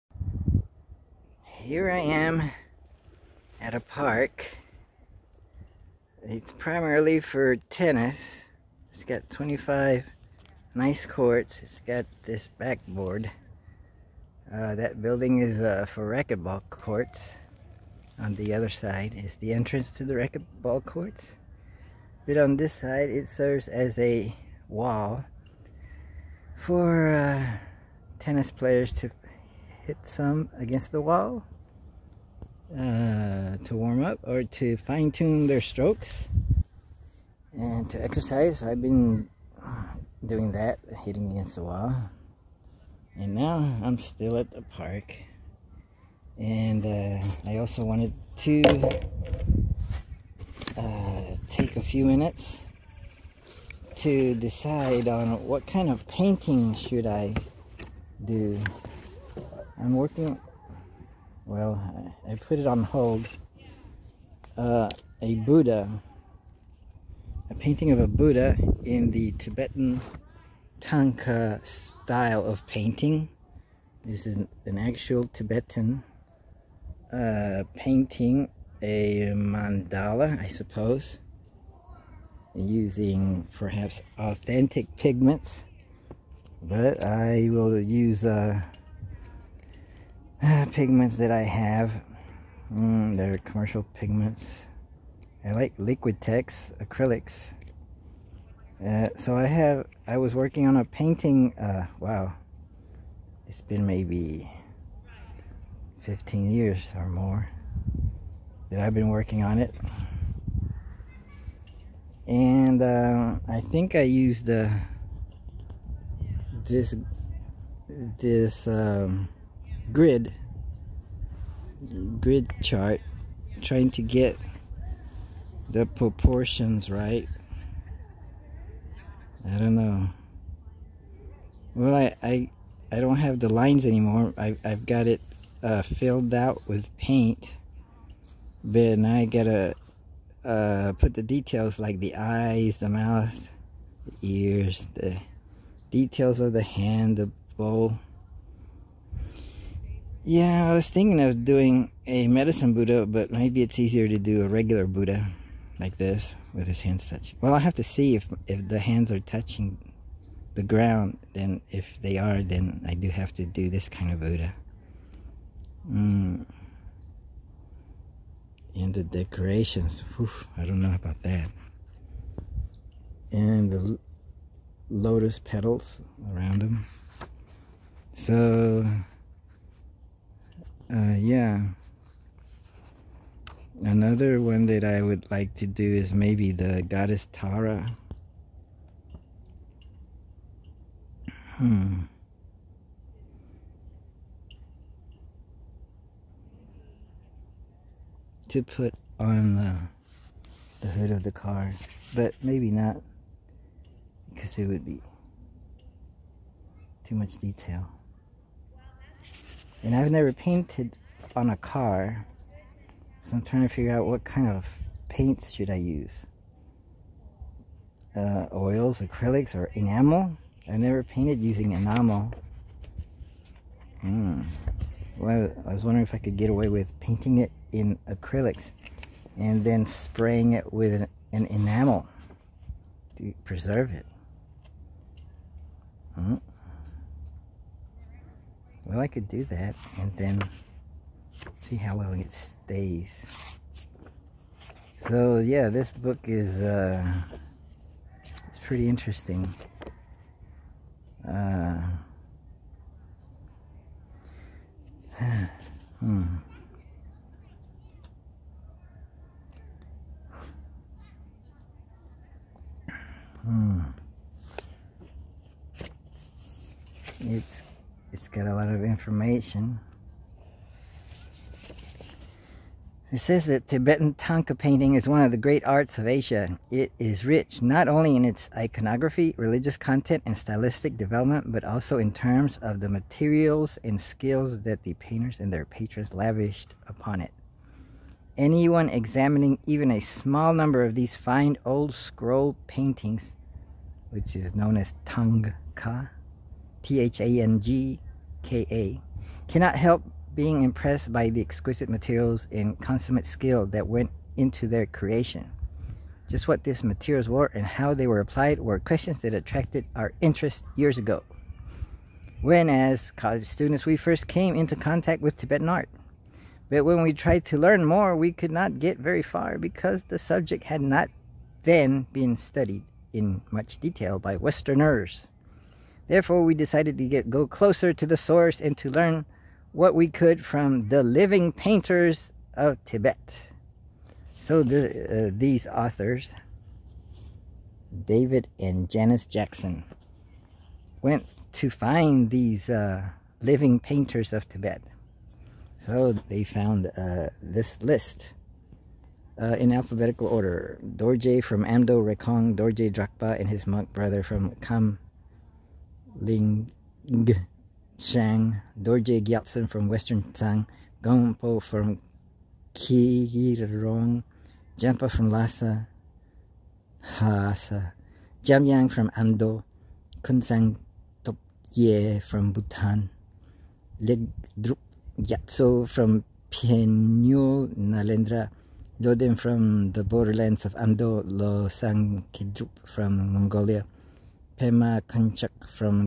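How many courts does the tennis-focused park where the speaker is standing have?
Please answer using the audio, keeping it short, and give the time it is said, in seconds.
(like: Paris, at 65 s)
25, at 9 s.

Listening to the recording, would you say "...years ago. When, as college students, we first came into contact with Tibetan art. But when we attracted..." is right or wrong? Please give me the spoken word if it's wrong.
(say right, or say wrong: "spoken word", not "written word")
wrong: "tried", not "attracted".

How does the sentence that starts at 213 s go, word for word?
So I'm trying to figure out what kind of paints should I use.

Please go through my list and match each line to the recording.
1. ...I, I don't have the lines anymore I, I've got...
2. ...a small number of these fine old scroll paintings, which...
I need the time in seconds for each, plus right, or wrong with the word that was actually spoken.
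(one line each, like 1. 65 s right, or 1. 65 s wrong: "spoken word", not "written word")
1. 132 s right
2. 289 s right.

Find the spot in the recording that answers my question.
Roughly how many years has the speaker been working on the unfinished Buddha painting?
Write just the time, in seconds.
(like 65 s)
106 s.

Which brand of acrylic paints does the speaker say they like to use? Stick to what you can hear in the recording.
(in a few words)
Liquitex.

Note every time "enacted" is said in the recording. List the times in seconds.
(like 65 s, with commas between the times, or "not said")
not said.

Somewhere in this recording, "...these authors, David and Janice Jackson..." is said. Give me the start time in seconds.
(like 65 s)
335 s.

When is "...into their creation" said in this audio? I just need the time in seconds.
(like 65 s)
304 s.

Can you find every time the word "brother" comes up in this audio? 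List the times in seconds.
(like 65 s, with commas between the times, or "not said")
353 s.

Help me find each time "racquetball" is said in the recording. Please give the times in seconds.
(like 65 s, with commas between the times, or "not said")
16 s, 20 s.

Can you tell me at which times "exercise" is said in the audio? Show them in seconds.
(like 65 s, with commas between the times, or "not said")
38 s.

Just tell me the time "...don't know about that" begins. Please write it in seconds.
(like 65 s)
170 s.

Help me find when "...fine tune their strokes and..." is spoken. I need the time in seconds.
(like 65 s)
34 s.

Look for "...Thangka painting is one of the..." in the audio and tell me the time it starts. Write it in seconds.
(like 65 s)
274 s.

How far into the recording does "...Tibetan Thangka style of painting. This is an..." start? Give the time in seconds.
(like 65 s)
69 s.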